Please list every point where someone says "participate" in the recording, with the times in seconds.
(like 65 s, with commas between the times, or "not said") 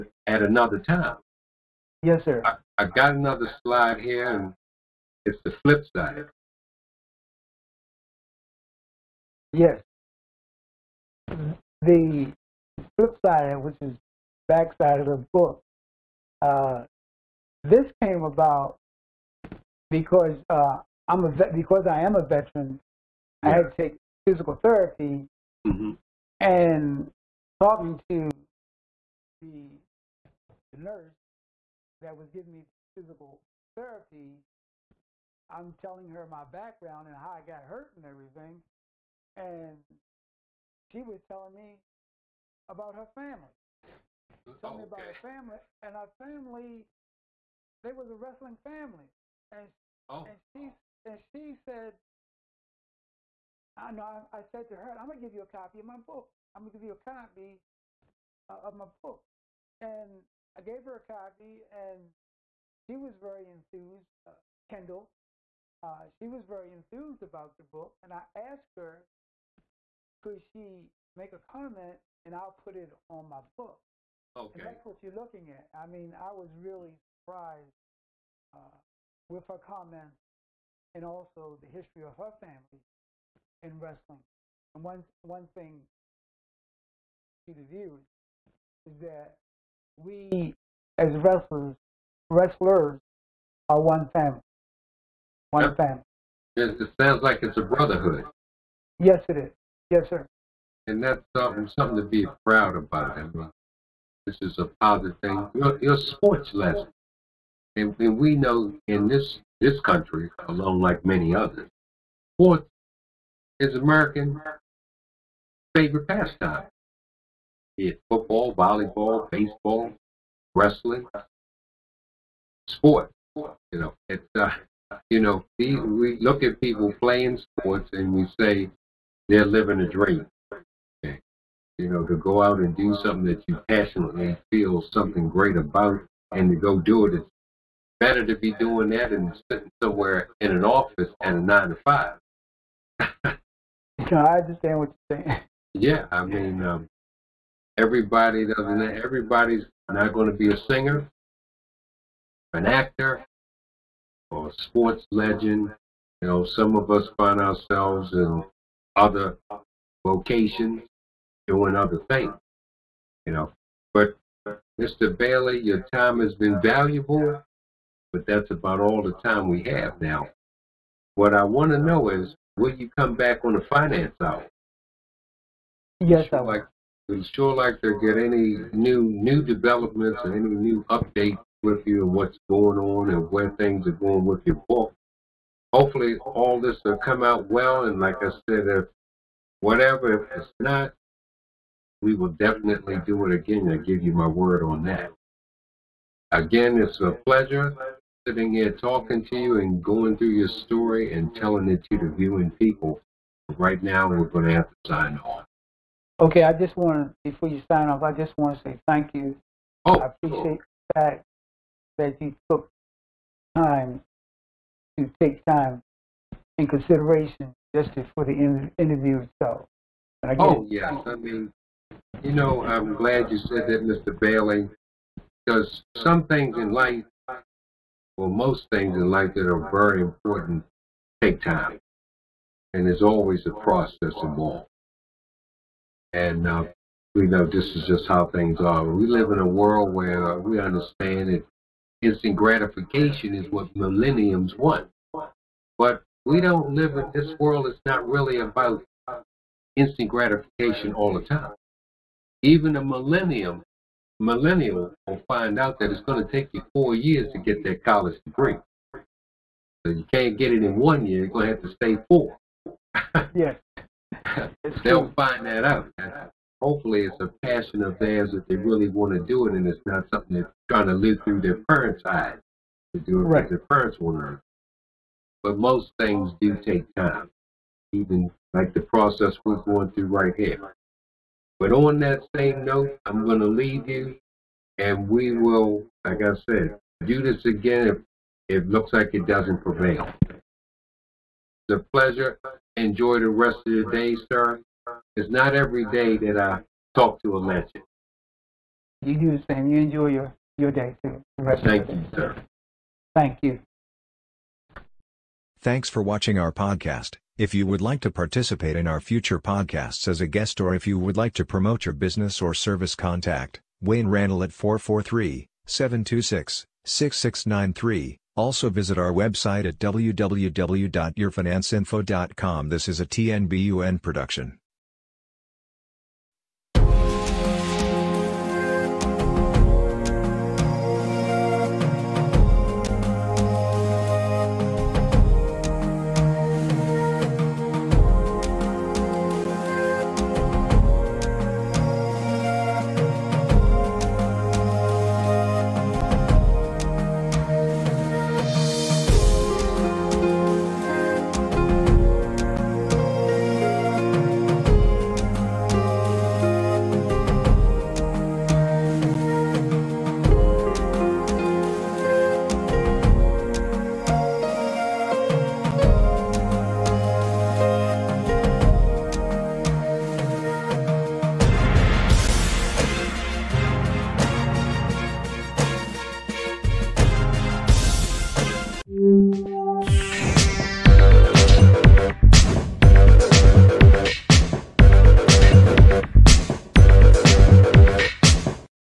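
308 s.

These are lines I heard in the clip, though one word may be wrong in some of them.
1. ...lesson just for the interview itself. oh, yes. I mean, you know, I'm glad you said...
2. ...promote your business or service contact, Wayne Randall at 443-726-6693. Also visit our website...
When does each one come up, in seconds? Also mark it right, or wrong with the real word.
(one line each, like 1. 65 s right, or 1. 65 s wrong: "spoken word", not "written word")
1. 216 s wrong: "consideration", not "lesson"
2. 311 s right.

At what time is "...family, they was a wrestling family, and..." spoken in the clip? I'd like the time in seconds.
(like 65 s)
46 s.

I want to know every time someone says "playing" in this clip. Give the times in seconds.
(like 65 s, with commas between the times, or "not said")
127 s.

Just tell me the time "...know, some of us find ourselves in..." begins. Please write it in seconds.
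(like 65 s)
156 s.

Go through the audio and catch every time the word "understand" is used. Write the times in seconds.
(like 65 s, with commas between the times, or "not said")
144 s, 240 s.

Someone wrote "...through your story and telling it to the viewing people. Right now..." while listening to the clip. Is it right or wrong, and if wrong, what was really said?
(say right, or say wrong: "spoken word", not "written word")
right.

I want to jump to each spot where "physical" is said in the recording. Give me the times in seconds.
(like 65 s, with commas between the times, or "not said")
24 s, 32 s.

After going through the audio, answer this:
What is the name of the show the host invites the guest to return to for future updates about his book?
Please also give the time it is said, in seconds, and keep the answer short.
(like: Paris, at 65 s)
the finance hour, at 173 s.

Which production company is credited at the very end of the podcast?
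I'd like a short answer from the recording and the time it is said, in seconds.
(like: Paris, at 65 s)
TNBUN, at 323 s.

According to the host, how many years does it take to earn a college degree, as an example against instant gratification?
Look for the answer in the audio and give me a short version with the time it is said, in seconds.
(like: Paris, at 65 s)
4, at 256 s.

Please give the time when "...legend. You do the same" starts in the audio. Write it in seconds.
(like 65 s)
297 s.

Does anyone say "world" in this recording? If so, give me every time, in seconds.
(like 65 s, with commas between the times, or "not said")
239 s, 247 s.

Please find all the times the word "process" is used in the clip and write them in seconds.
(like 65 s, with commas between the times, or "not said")
233 s, 278 s.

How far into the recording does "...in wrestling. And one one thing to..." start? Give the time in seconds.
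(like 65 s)
83 s.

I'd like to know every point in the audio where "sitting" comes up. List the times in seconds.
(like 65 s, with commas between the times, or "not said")
139 s, 198 s.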